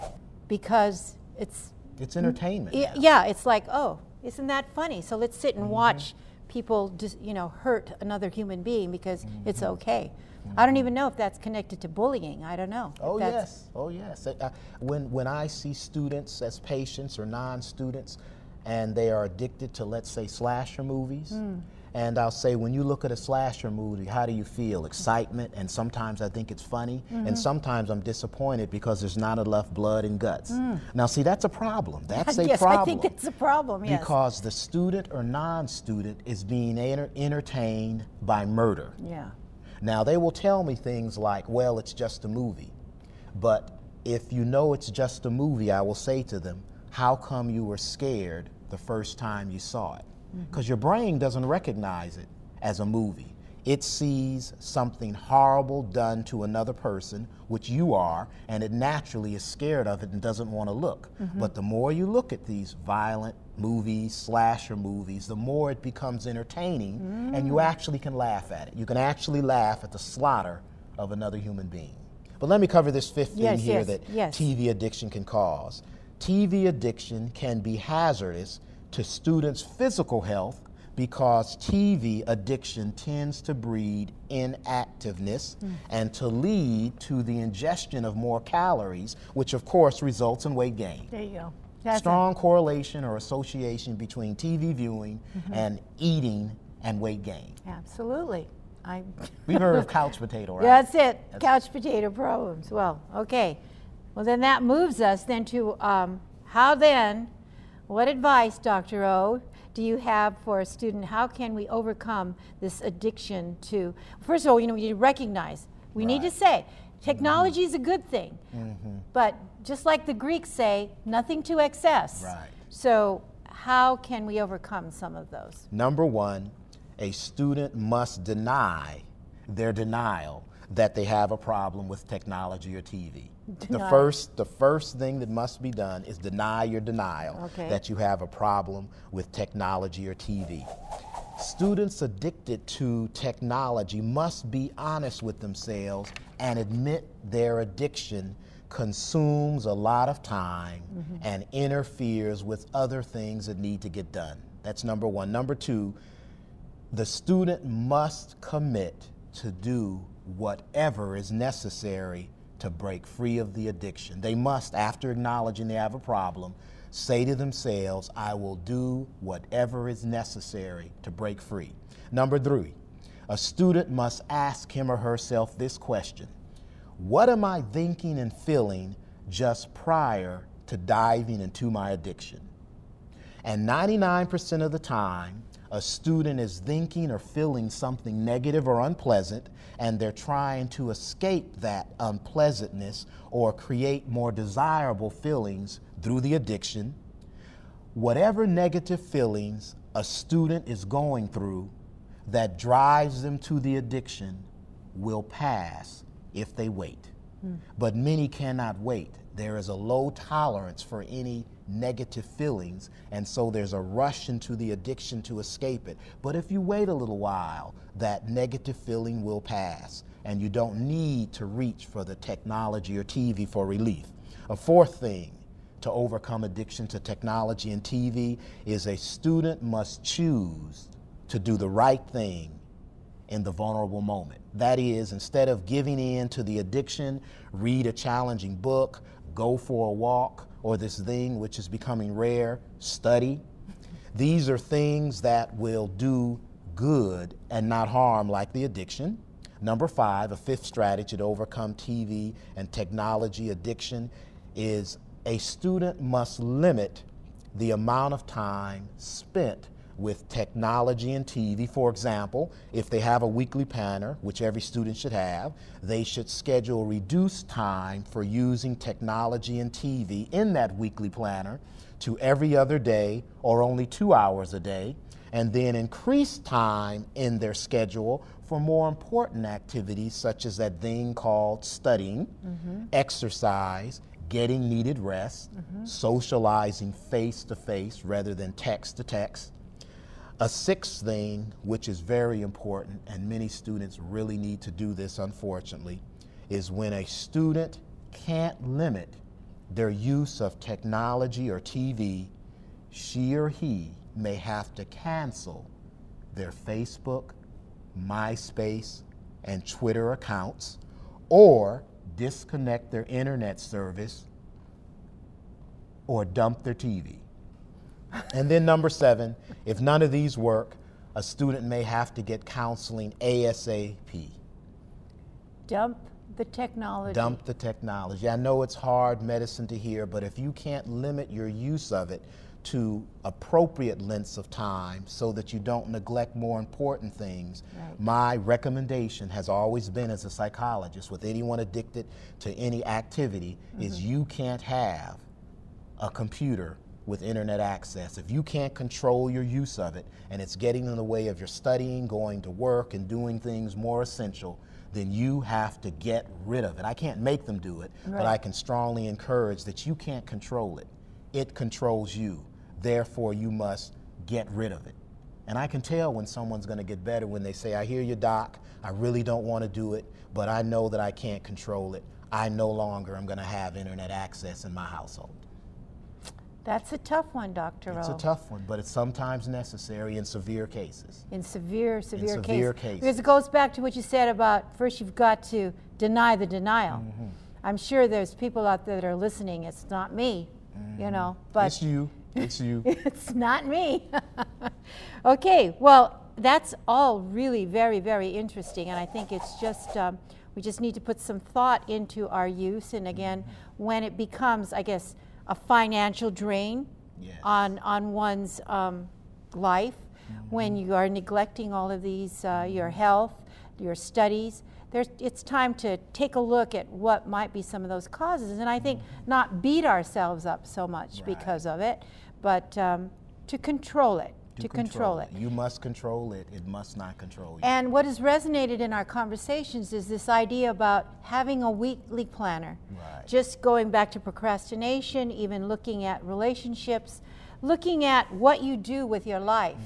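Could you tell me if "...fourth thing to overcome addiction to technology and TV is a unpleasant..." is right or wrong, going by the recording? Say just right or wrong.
wrong.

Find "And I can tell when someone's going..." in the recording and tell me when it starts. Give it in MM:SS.
06:05.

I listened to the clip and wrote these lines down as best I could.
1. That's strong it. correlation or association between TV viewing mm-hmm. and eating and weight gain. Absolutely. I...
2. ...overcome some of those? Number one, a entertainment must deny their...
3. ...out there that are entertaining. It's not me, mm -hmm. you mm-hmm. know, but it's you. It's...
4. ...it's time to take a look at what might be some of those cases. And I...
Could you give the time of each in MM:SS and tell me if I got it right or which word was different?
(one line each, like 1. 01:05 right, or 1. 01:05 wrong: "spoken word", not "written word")
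1. 01:31 right
2. 02:04 wrong: "student", not "entertainment"
3. 06:28 wrong: "listening", not "entertaining"
4. 06:55 wrong: "causes", not "cases".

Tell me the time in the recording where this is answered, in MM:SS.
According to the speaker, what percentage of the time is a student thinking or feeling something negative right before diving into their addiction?
03:03.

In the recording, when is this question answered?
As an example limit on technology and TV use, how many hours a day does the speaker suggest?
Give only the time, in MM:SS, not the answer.
04:33.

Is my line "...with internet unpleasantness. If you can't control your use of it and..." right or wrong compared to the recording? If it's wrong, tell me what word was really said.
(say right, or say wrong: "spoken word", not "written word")
wrong: "access", not "unpleasantness".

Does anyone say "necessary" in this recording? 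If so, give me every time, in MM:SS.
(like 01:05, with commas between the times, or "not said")
02:41, 02:50, 06:19.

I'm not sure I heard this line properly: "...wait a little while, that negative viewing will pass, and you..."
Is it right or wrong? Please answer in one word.
wrong.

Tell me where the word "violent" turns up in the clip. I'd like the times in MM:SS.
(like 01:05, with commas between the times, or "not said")
01:02.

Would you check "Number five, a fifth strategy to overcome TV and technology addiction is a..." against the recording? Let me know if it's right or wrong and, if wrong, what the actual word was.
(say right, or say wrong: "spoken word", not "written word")
right.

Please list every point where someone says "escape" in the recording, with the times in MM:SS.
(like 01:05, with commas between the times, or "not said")
03:10, 03:35.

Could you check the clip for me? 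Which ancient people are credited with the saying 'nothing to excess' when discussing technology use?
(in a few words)
the Greeks.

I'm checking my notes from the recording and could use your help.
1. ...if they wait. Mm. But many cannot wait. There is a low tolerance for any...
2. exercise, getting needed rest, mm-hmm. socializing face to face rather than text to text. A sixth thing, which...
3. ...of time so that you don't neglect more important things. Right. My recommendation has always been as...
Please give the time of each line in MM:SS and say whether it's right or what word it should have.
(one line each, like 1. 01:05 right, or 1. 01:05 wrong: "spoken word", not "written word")
1. 03:26 right
2. 04:42 right
3. 05:34 right.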